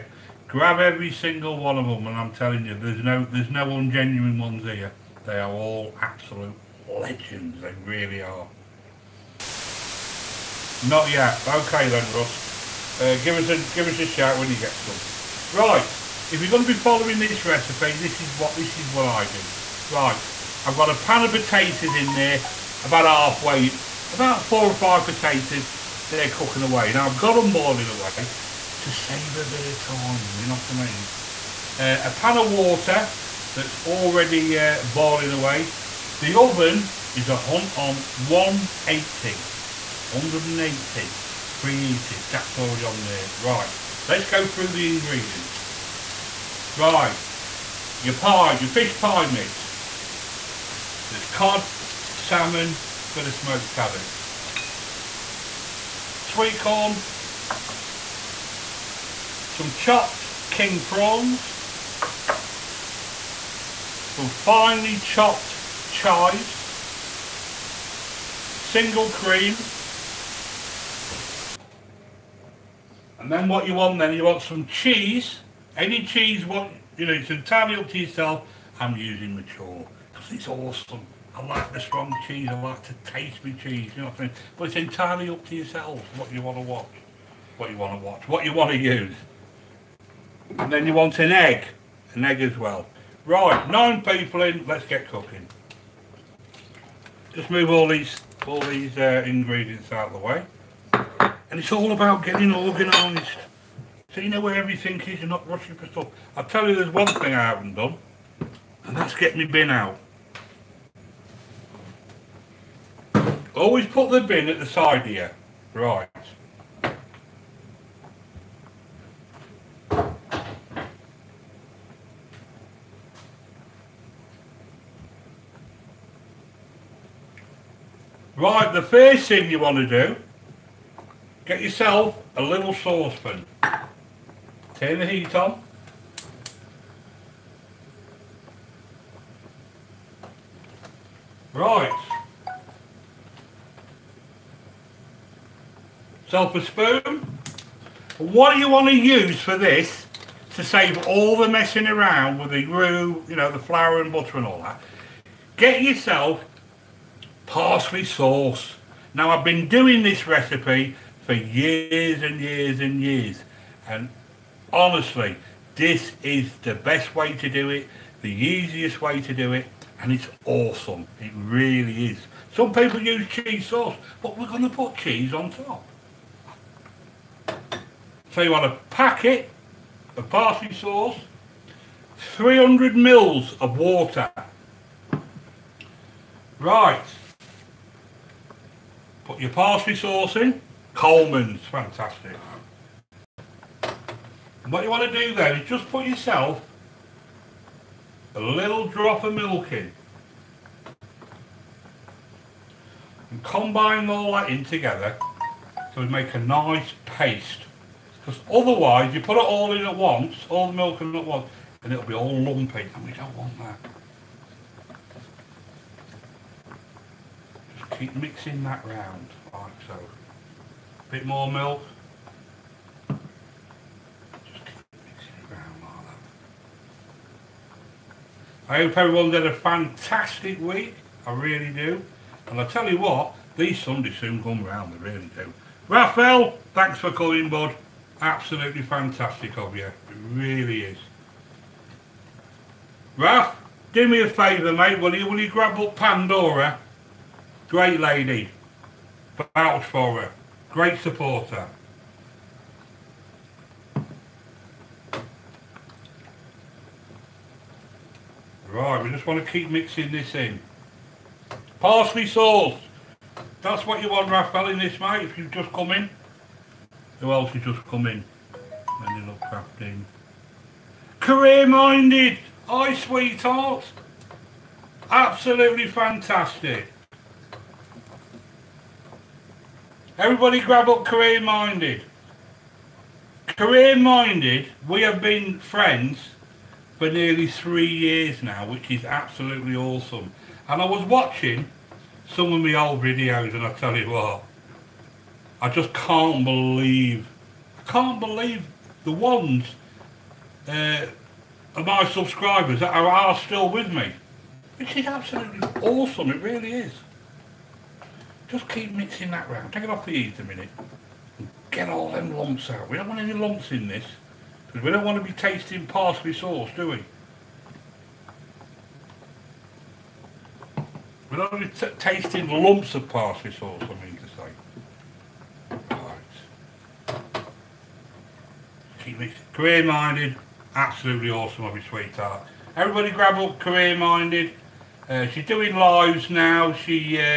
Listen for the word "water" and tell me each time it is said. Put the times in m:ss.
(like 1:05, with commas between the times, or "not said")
0:32, 3:03.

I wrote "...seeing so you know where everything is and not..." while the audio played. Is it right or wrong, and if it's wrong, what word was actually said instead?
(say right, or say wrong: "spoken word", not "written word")
right.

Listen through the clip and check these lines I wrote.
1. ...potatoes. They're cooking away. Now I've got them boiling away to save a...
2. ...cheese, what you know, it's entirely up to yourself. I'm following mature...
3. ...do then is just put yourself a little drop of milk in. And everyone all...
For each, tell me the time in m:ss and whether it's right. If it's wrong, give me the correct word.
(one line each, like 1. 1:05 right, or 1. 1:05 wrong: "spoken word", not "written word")
1. 0:25 right
2. 1:16 wrong: "using", not "following"
3. 3:15 wrong: "combine", not "everyone".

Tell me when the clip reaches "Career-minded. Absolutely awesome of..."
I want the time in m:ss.
5:29.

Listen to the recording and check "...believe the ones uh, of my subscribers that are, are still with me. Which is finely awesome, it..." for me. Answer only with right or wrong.
wrong.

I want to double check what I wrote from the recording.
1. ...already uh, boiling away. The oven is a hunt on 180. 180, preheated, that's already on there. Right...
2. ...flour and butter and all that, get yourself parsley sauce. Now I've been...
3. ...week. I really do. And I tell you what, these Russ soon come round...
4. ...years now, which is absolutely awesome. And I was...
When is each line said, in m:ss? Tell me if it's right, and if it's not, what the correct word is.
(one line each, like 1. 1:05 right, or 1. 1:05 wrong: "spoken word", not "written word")
1. 0:33 right
2. 2:33 right
3. 3:50 wrong: "Sundays", not "Russ"
4. 4:47 right.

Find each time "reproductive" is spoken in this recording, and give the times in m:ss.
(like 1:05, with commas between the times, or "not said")
not said.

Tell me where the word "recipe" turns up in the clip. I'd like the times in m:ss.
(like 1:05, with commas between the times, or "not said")
0:17, 2:40.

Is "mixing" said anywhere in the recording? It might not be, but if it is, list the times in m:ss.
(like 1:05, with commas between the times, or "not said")
3:38, 4:19, 5:08, 5:29.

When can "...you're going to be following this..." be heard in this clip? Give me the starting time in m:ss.
0:16.